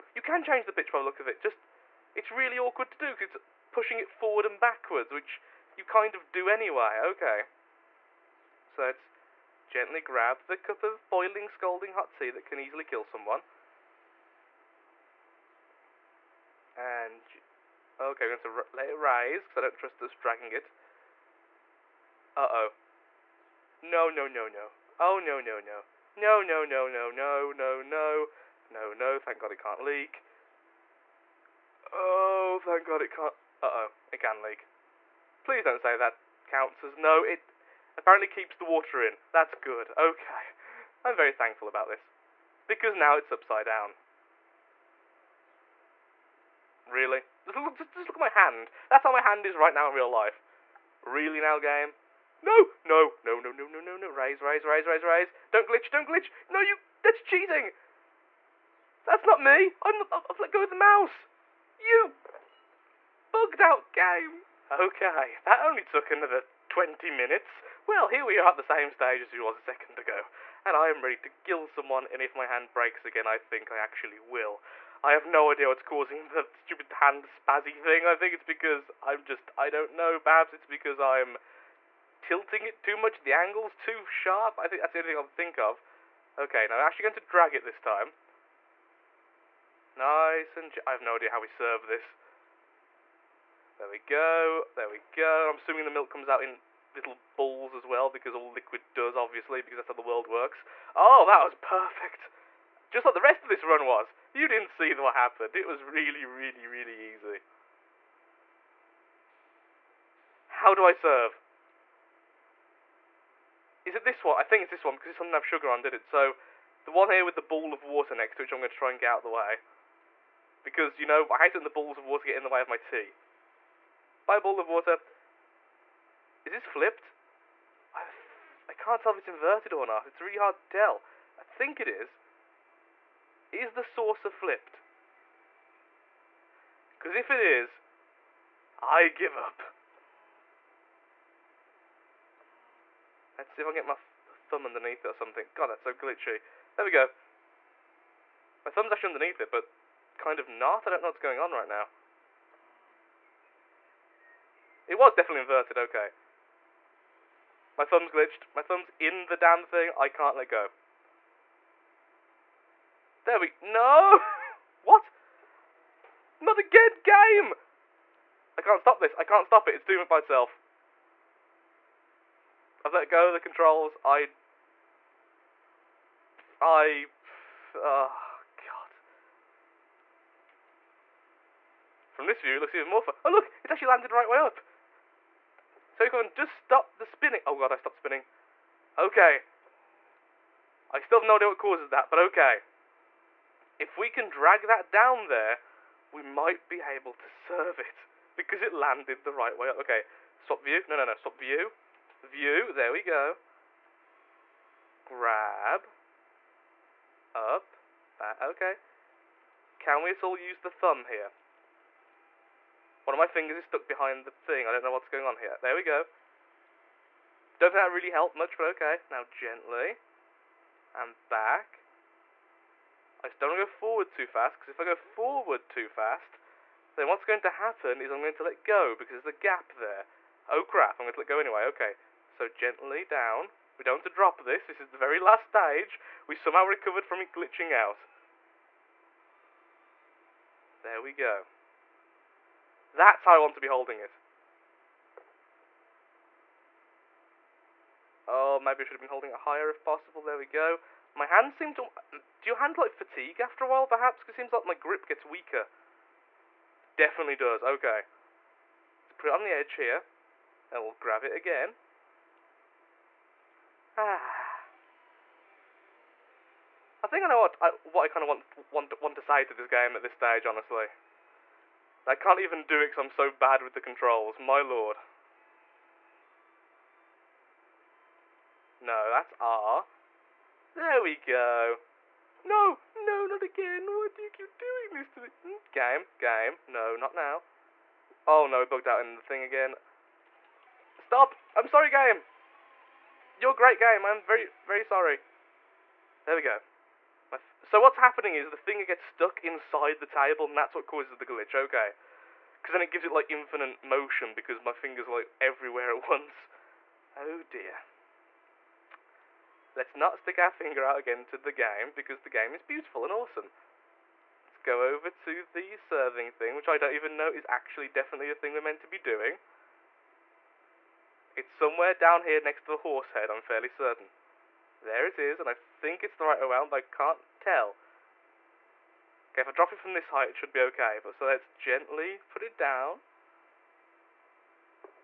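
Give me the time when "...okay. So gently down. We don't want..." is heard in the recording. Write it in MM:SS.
03:51.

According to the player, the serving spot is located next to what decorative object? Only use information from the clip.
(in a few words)
the horse head.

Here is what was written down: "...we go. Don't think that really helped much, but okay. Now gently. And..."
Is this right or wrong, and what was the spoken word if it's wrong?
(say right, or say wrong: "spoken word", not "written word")
right.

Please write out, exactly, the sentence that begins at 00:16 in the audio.
and okay, I'm going to let it rise because I don't trust us dragging it.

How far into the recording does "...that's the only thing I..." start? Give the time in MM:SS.
01:24.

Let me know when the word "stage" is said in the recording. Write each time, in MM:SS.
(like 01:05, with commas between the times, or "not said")
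01:08, 03:55, 04:30.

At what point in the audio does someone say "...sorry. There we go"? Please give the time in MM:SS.
04:54.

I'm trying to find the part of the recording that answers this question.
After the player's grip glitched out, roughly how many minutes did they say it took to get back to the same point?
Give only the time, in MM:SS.
01:06.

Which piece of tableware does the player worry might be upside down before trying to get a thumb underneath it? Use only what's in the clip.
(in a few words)
the saucer.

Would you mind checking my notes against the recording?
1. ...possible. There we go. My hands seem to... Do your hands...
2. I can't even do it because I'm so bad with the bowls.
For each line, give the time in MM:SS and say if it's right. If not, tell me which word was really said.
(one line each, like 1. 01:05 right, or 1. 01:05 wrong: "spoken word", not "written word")
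1. 04:09 right
2. 04:32 wrong: "controls", not "bowls".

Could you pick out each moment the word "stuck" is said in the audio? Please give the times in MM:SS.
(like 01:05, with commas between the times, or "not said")
03:33, 04:59.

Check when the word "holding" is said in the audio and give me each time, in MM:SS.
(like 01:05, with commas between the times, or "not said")
04:03, 04:09.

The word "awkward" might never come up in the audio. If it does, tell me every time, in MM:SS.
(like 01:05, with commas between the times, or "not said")
00:02.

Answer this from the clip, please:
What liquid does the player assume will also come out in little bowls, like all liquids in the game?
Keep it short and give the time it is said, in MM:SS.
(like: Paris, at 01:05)
milk, at 01:35.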